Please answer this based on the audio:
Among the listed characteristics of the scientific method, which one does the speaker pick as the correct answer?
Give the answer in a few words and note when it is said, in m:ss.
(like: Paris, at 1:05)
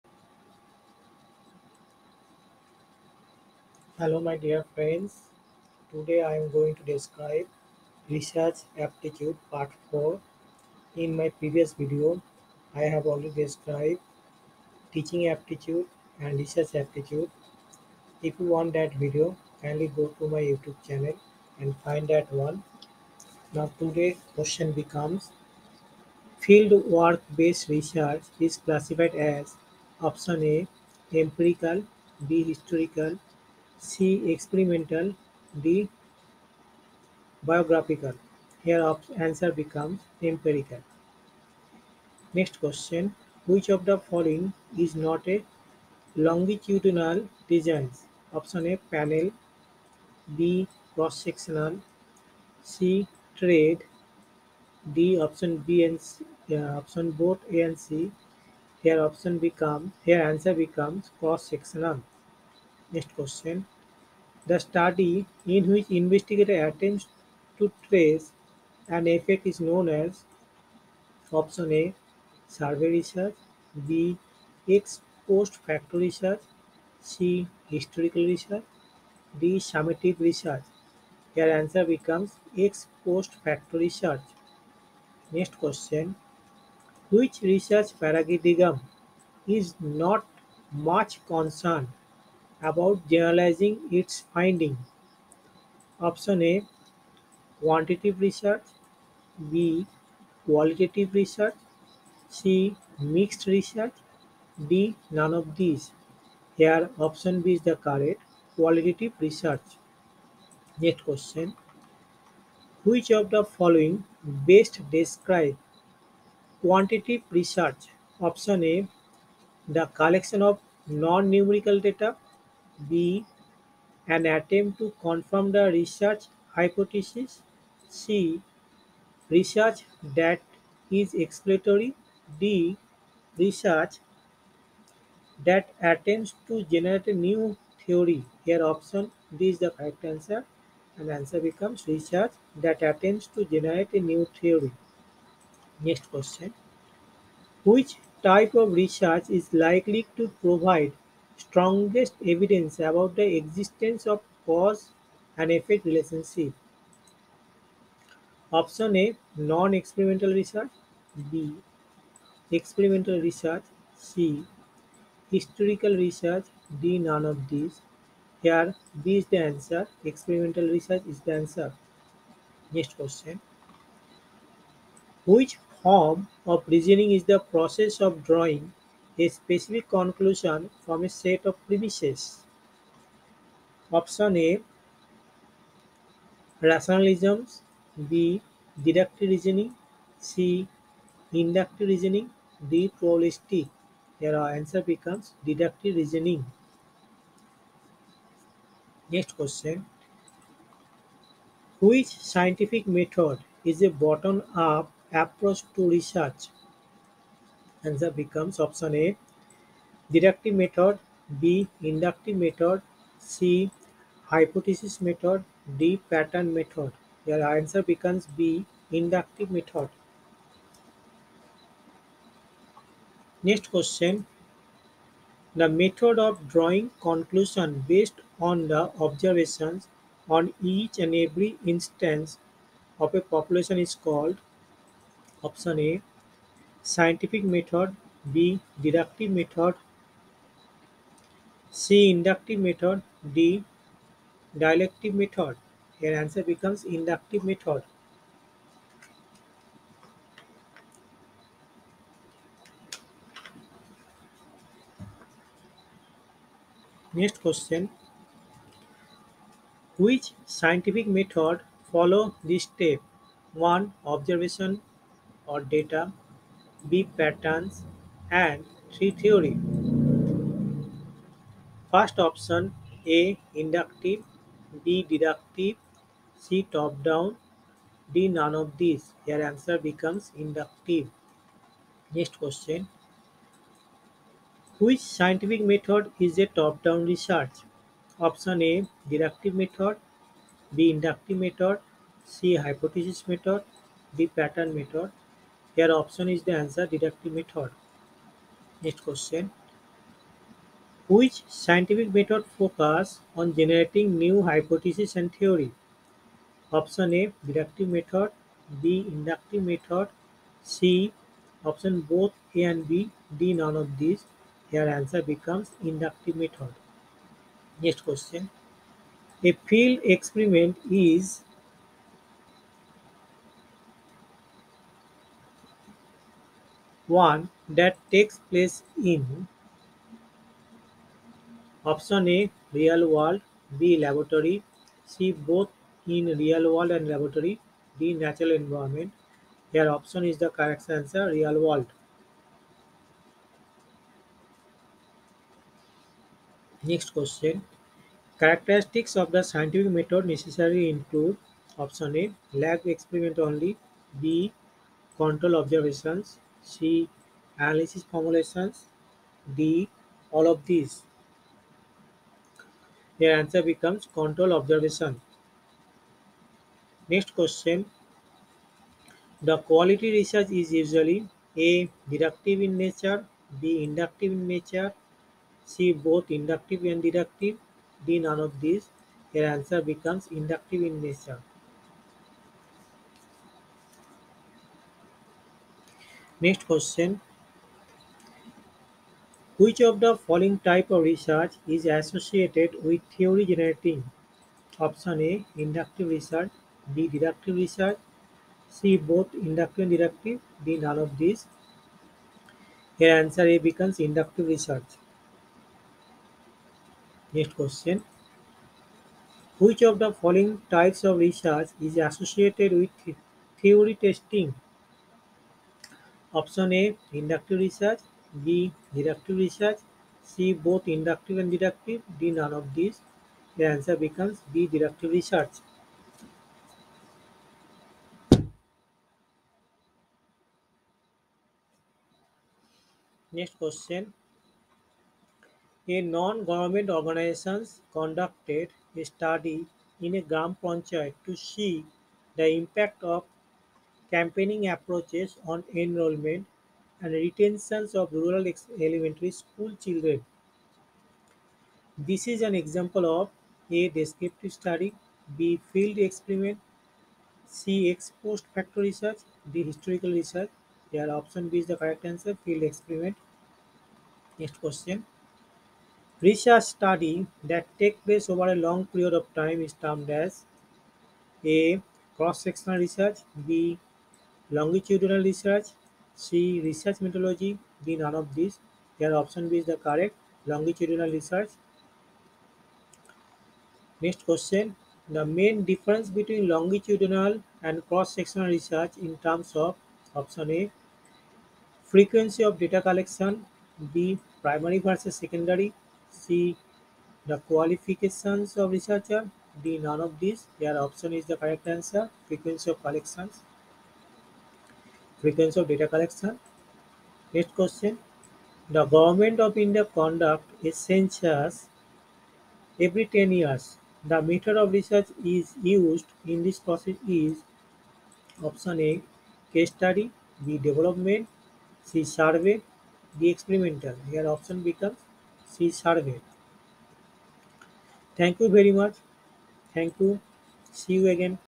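Control observations, at 6:03.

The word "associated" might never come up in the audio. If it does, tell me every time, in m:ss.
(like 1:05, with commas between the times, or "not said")
6:31, 6:51.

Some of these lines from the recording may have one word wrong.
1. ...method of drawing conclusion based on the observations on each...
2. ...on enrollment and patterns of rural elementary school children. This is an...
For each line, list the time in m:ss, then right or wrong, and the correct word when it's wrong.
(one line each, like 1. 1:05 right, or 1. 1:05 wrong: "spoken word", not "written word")
1. 3:45 right
2. 7:25 wrong: "retentions", not "patterns".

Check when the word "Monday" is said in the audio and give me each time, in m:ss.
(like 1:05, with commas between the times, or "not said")
not said.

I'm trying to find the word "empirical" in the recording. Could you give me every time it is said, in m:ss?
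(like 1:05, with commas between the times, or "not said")
0:31, 0:40.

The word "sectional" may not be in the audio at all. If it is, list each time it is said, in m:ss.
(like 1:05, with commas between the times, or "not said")
0:50, 1:01, 7:52, 8:07.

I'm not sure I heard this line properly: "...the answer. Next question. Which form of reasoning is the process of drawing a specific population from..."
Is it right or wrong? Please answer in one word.
wrong.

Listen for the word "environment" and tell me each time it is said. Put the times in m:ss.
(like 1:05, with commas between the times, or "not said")
5:38.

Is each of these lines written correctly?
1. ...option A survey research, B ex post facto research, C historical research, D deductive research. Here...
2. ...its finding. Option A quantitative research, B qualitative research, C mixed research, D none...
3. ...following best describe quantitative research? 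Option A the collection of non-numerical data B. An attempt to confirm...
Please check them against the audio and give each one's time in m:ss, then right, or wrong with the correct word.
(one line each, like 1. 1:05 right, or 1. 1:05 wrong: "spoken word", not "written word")
1. 1:11 wrong: "summative", not "deductive"
2. 1:33 right
3. 1:53 right.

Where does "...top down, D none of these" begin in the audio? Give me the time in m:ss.
4:36.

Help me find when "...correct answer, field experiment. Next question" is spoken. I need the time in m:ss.
7:41.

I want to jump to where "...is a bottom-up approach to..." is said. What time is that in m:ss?
3:23.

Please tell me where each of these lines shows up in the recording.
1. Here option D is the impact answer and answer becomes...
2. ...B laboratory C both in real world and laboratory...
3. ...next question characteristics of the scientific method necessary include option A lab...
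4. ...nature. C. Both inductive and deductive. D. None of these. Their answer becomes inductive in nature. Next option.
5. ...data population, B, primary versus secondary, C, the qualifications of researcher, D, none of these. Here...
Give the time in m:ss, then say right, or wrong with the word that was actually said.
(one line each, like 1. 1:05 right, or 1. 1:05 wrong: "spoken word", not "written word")
1. 2:18 wrong: "correct", not "impact"
2. 5:33 right
3. 5:46 right
4. 6:14 wrong: "question", not "option"
5. 8:12 wrong: "collection", not "population".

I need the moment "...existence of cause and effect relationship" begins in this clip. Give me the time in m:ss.
2:33.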